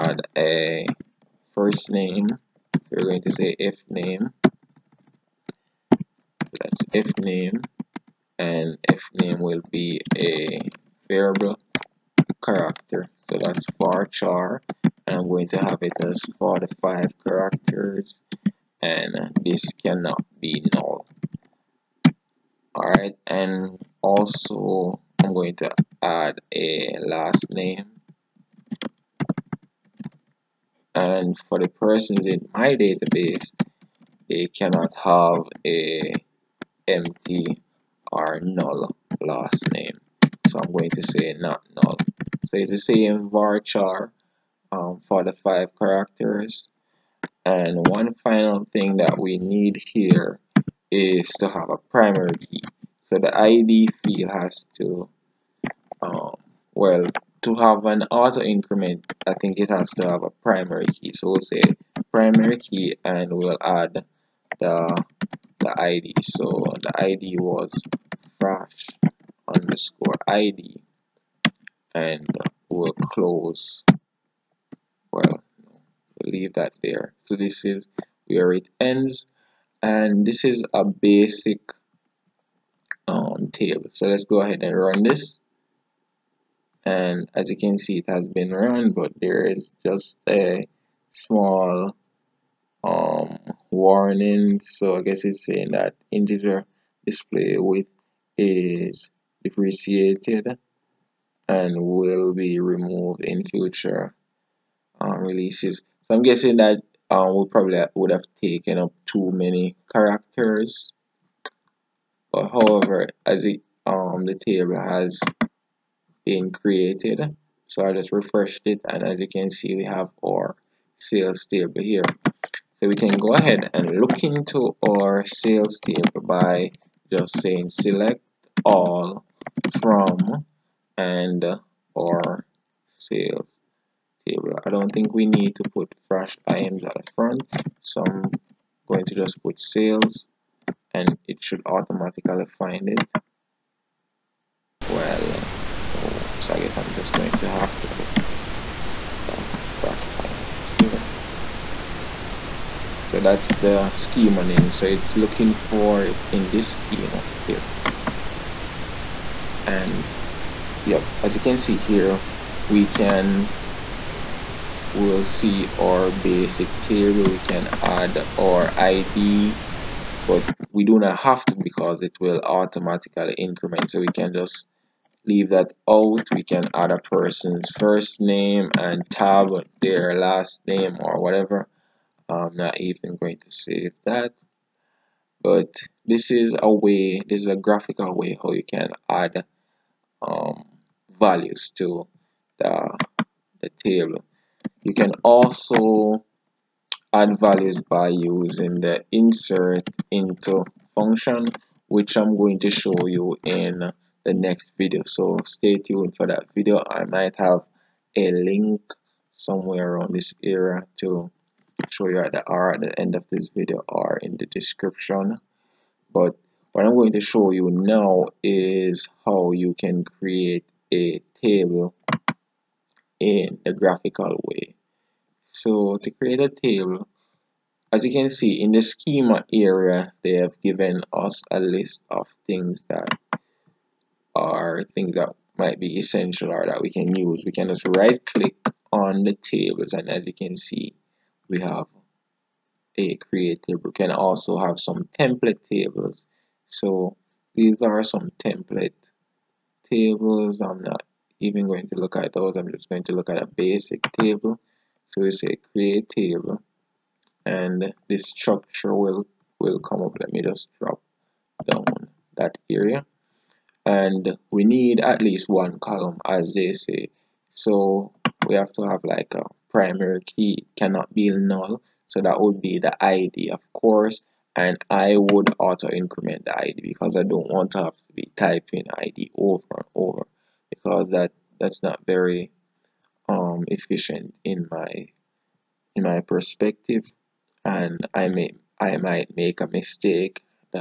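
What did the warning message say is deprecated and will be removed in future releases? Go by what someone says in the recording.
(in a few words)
integer display width.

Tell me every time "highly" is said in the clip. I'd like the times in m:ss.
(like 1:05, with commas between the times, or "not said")
not said.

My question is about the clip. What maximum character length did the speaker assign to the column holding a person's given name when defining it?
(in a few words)
45.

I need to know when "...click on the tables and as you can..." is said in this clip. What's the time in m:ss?
3:58.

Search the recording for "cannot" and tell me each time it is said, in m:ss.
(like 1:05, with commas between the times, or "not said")
0:19, 0:34, 4:30.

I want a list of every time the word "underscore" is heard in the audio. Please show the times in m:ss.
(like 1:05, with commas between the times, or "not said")
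1:09.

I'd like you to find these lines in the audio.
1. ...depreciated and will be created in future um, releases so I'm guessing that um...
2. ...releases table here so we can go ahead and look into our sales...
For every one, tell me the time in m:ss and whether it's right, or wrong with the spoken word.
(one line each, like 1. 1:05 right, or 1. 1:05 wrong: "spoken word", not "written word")
1. 1:39 wrong: "removed", not "created"
2. 2:00 wrong: "sales", not "releases".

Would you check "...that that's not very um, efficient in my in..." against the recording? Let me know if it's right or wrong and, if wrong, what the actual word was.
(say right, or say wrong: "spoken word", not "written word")
right.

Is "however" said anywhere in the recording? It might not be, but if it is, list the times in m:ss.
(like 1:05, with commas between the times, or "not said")
1:52.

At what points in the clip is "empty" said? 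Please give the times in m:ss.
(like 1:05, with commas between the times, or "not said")
0:36.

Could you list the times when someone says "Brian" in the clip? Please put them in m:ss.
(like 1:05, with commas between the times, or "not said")
not said.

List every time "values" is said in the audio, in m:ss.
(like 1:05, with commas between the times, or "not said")
3:11, 3:17.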